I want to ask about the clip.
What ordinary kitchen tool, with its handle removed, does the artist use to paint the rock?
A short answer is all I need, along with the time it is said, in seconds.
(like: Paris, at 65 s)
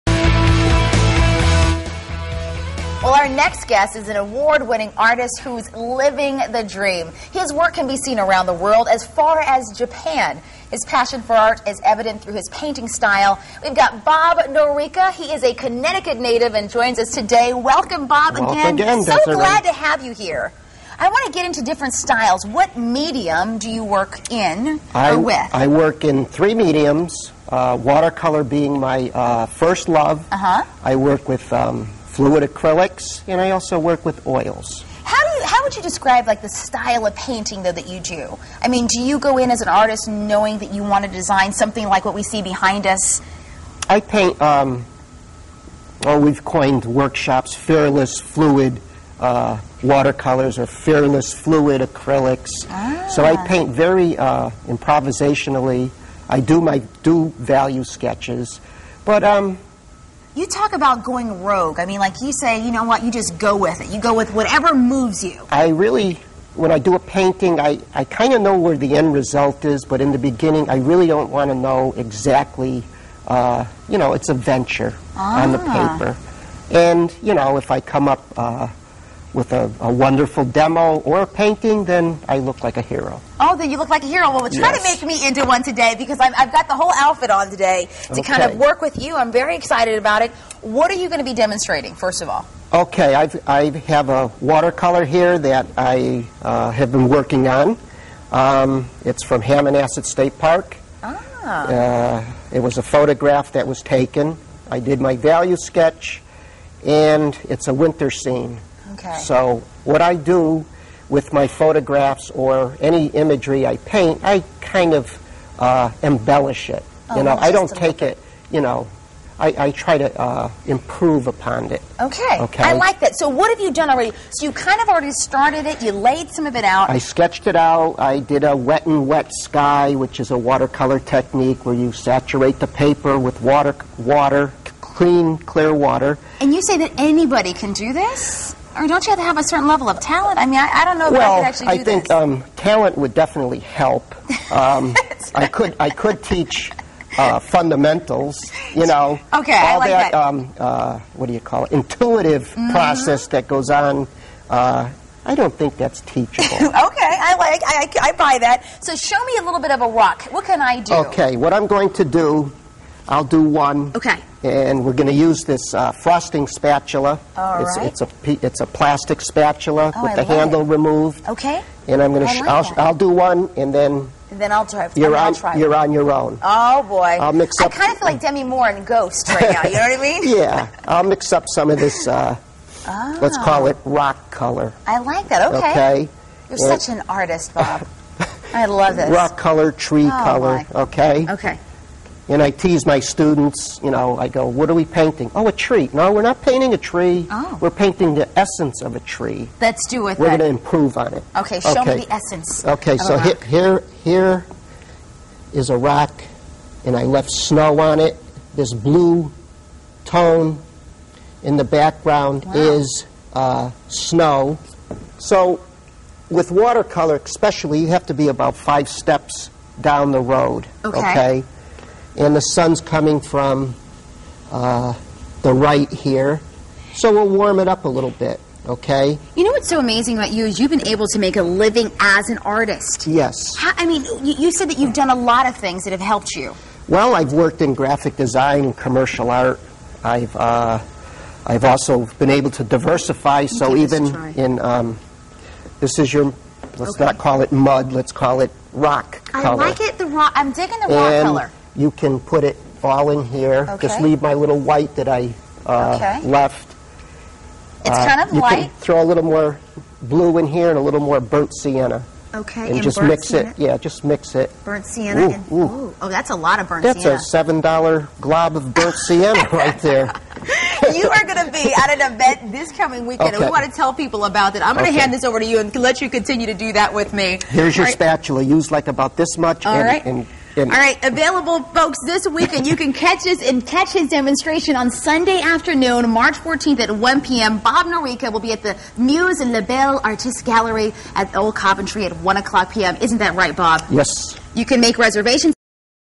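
Frosting spatula, at 165 s.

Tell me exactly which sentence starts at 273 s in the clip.
and we want to tell people about it.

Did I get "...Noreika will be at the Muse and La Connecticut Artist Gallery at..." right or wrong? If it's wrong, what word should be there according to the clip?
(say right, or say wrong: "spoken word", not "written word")
wrong: "Belle", not "Connecticut".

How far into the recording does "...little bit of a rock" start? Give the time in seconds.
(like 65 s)
159 s.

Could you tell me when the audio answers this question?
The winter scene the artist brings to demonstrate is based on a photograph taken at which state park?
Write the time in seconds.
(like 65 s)
99 s.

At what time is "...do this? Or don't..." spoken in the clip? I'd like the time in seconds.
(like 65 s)
137 s.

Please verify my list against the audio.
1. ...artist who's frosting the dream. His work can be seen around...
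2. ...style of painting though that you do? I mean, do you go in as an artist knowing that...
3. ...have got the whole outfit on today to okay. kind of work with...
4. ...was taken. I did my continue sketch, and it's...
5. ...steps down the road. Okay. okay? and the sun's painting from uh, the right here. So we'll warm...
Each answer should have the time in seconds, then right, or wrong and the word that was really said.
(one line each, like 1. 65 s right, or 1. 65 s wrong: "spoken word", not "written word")
1. 4 s wrong: "living", not "frosting"
2. 36 s right
3. 86 s right
4. 103 s wrong: "value", not "continue"
5. 218 s wrong: "coming", not "painting".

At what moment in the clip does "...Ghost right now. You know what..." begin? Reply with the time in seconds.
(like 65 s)
178 s.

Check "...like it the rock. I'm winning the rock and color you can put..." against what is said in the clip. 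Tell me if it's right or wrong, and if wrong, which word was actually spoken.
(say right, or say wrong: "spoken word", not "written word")
wrong: "digging", not "winning".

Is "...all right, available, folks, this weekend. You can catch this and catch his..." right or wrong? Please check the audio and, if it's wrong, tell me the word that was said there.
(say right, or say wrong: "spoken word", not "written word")
right.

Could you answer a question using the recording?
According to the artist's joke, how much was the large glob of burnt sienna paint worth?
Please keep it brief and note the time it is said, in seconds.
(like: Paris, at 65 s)
$7, at 267 s.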